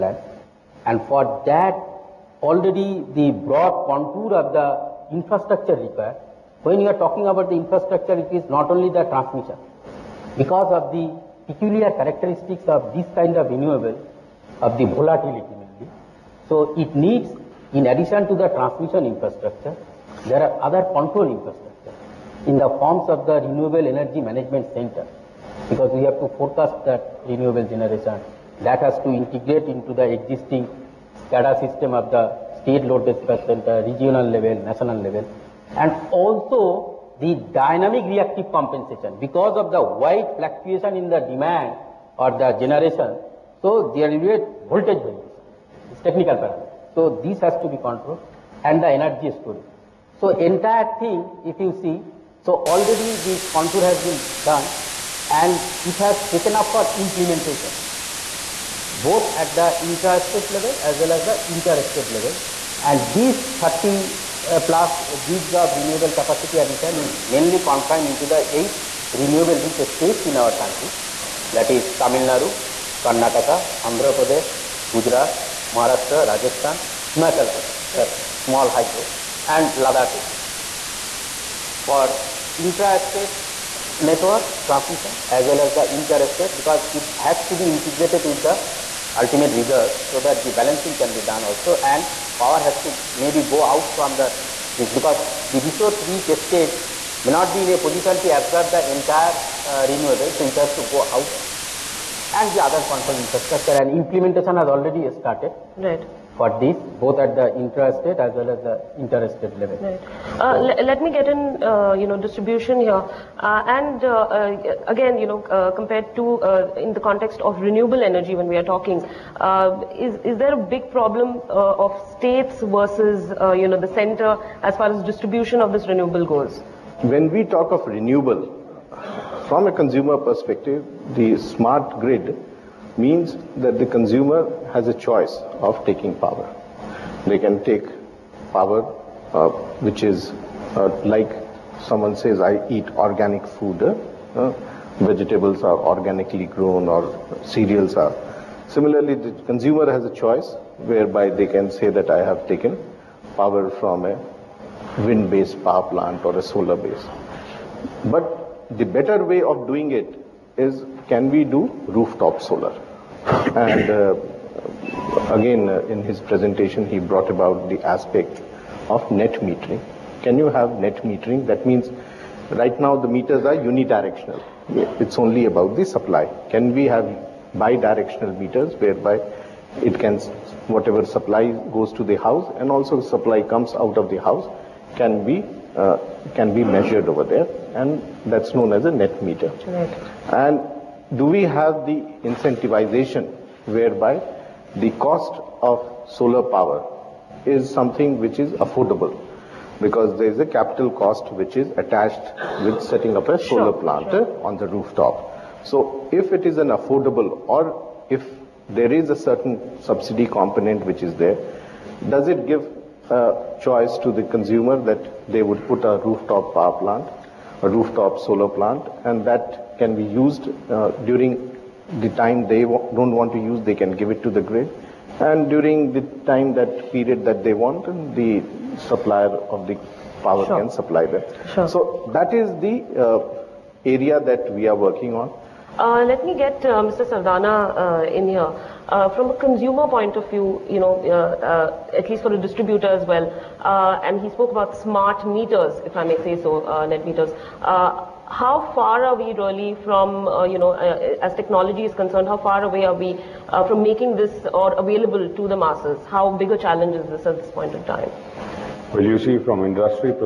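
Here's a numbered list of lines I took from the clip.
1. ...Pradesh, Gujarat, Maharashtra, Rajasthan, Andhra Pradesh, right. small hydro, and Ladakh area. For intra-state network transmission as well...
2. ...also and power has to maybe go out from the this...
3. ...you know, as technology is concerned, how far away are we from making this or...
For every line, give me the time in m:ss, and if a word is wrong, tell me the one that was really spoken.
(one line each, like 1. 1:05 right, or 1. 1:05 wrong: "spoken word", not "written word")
1. 1:14 wrong: "Himachal", not "Andhra"
2. 1:31 right
3. 4:10 right.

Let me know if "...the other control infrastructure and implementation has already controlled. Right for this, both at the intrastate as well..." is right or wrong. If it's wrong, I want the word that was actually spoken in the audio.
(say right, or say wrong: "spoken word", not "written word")
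wrong: "started", not "controlled".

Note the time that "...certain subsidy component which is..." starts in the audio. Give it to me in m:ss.
3:29.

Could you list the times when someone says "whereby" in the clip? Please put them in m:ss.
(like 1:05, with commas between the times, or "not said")
2:30, 2:58, 3:13.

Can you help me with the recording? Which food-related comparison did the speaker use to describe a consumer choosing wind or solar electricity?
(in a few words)
organic food.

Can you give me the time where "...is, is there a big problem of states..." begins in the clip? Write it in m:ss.
2:00.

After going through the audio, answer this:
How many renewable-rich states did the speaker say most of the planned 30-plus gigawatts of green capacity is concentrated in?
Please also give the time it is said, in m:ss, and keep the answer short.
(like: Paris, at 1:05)
8, at 1:08.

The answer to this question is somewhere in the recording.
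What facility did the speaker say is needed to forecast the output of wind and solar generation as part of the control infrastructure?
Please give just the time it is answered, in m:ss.
0:23.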